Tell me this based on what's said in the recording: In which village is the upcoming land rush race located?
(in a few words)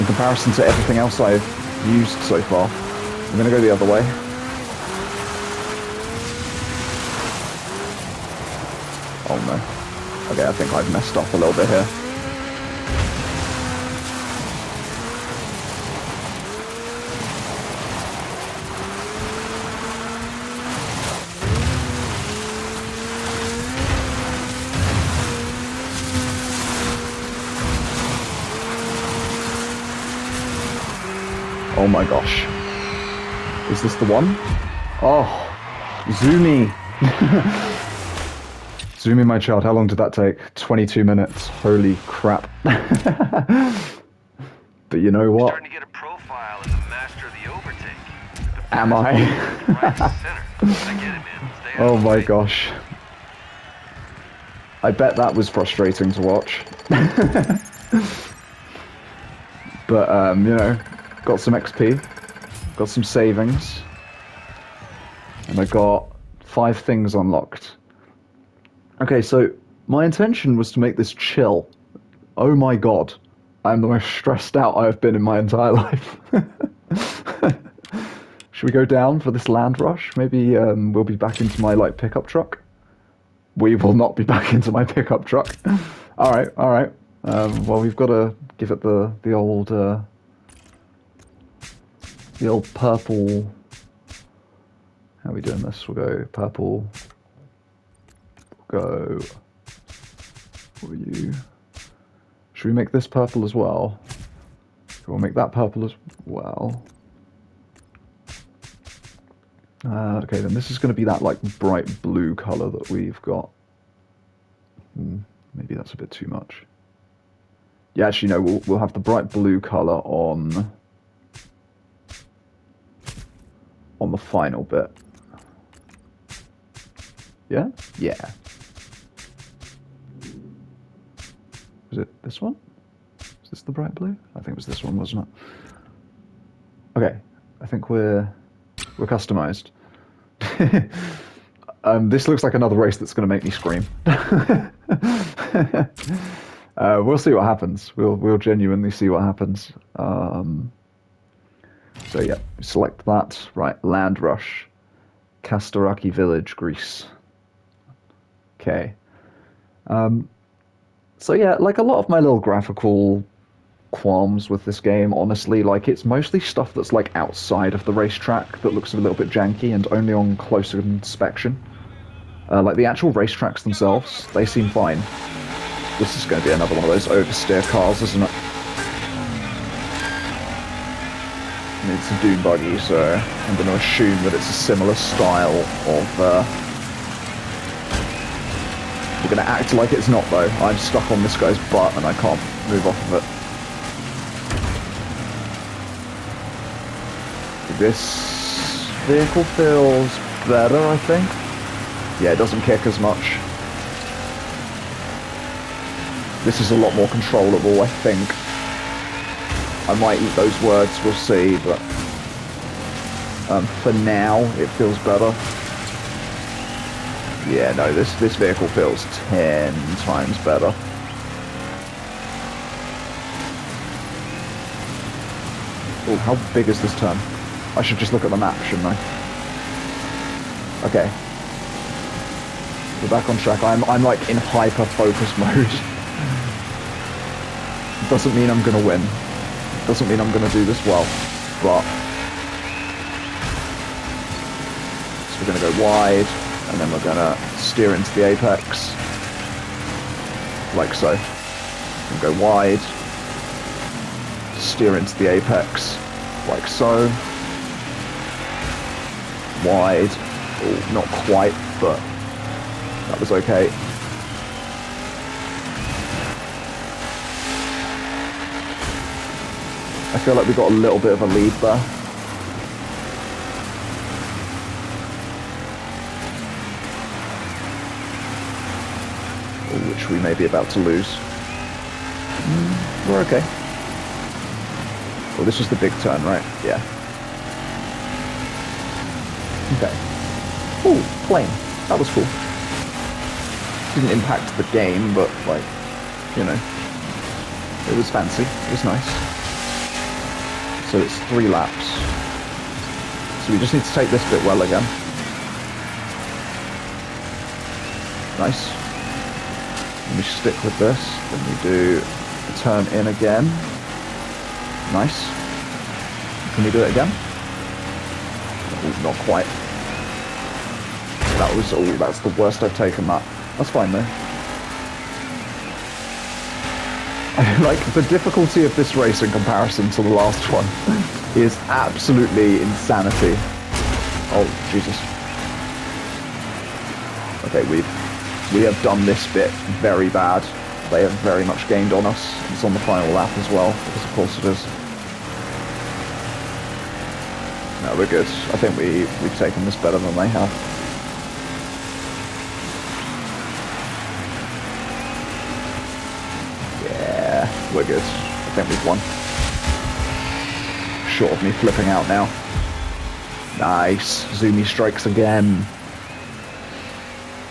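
Kastaraki Village.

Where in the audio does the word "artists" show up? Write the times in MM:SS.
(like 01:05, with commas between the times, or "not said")
not said.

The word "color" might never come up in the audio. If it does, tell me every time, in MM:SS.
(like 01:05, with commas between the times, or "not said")
01:52, 01:59.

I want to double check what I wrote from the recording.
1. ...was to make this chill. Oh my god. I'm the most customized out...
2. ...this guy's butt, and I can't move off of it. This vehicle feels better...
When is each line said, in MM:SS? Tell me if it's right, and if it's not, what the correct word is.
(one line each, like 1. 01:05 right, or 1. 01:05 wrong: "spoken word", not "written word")
1. 01:10 wrong: "stressed", not "customized"
2. 03:11 right.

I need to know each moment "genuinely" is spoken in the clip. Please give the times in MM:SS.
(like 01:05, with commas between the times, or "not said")
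02:28.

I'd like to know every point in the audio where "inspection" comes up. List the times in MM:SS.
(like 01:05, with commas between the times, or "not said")
02:50.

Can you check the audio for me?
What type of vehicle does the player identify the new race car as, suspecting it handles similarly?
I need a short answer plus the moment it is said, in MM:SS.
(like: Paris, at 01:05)
Doom buggy, at 03:02.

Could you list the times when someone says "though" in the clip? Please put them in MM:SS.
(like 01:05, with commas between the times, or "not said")
03:10, 05:23.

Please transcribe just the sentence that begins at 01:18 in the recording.
Should we go down for this land rush?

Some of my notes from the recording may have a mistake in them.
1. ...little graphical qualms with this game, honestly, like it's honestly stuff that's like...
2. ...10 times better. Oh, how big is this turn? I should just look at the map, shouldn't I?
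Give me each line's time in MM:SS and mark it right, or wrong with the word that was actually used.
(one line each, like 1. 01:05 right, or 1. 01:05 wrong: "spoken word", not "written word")
1. 02:42 wrong: "mostly", not "honestly"
2. 03:39 right.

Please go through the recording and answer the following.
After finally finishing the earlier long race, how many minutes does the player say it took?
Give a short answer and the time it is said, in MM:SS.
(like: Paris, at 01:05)
22 minutes, at 00:40.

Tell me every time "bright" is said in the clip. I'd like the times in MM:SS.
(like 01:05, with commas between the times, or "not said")
01:51, 01:58, 02:13.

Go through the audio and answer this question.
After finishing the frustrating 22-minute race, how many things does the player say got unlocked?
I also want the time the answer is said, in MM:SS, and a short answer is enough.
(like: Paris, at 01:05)
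5, at 01:06.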